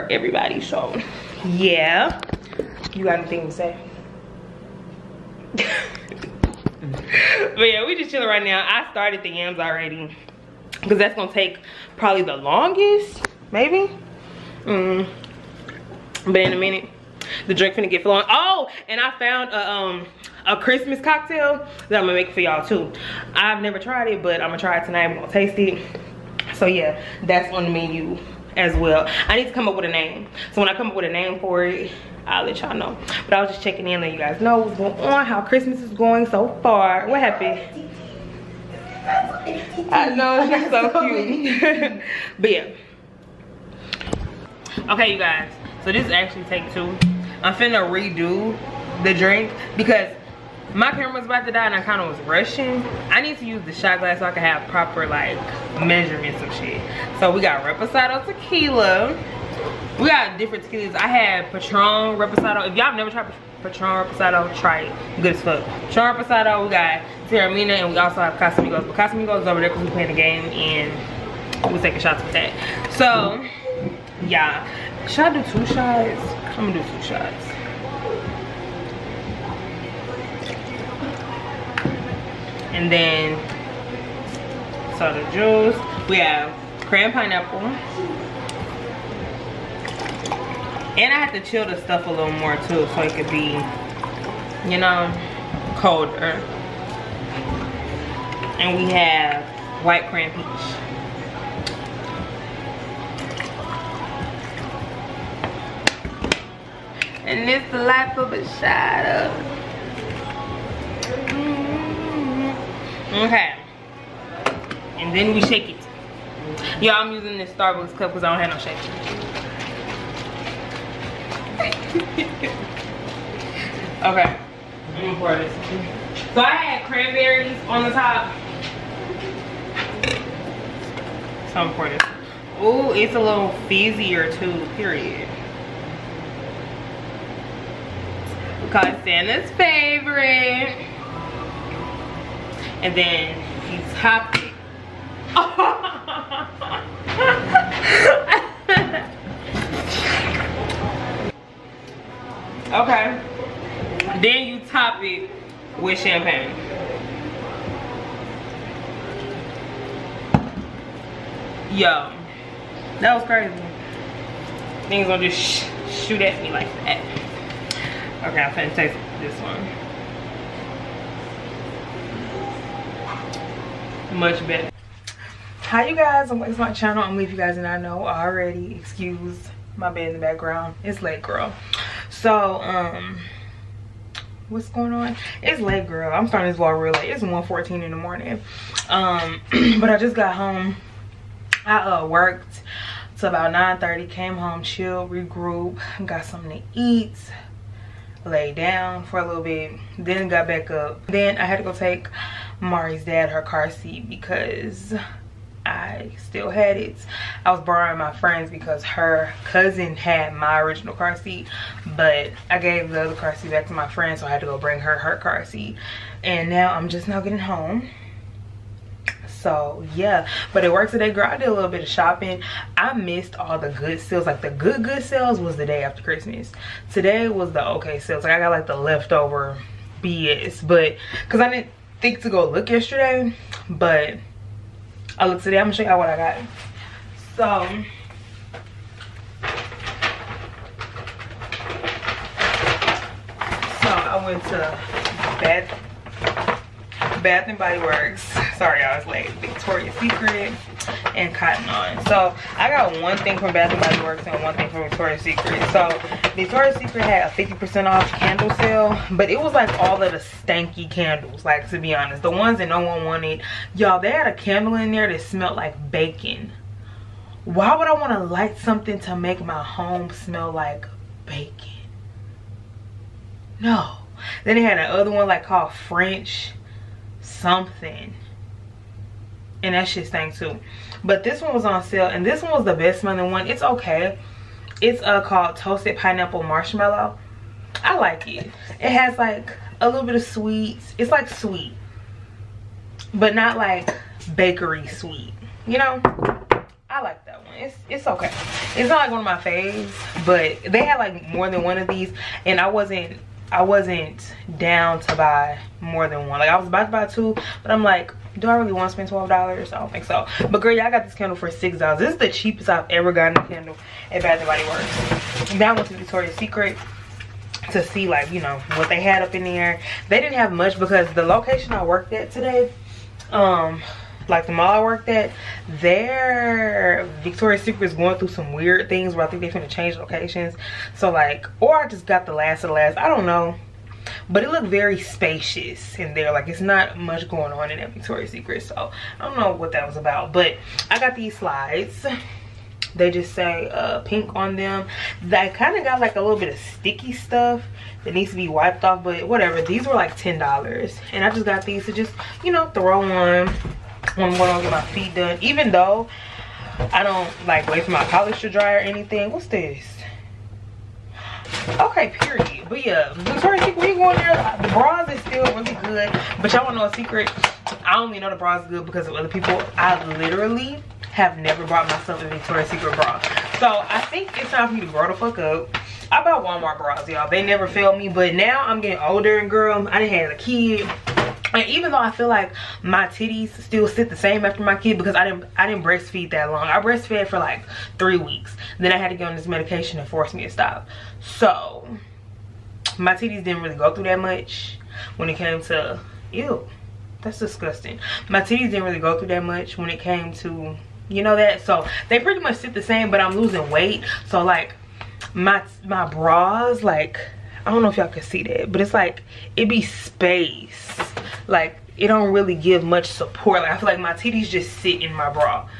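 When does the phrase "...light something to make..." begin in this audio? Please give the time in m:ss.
4:28.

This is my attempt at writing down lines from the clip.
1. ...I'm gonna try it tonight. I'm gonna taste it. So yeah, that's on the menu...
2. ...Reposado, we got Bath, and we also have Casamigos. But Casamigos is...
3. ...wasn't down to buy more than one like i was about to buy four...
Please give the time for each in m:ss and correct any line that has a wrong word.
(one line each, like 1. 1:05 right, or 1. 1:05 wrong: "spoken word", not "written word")
1. 0:24 right
2. 1:06 wrong: "Teremana", not "Bath"
3. 5:03 wrong: "two", not "four".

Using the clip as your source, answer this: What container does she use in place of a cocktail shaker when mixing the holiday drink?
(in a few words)
Starbucks cup.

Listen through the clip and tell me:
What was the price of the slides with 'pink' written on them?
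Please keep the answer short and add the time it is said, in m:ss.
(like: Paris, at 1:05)
$10, at 5:50.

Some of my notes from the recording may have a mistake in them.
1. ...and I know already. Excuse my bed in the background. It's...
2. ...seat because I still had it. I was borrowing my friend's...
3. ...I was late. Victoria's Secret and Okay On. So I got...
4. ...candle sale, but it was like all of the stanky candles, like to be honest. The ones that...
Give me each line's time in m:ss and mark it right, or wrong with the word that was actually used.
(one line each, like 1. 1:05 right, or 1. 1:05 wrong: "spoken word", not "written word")
1. 2:57 right
2. 3:23 right
3. 4:08 wrong: "Cotton", not "Okay"
4. 4:18 right.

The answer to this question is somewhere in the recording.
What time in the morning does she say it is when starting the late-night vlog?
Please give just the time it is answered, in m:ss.
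3:07.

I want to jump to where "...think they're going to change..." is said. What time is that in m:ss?
5:29.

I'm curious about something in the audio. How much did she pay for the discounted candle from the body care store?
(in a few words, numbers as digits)
$6.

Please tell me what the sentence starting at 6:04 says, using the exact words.
The bras is still really good.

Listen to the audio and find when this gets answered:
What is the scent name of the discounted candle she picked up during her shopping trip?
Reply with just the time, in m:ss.
4:45.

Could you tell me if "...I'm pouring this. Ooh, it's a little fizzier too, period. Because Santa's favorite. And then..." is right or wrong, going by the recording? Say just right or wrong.
right.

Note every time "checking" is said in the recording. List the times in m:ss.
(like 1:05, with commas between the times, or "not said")
0:33.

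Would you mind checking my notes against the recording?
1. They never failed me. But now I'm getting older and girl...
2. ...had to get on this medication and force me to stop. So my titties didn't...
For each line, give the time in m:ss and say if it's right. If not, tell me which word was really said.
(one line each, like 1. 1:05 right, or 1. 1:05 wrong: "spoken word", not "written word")
1. 6:17 right
2. 6:28 right.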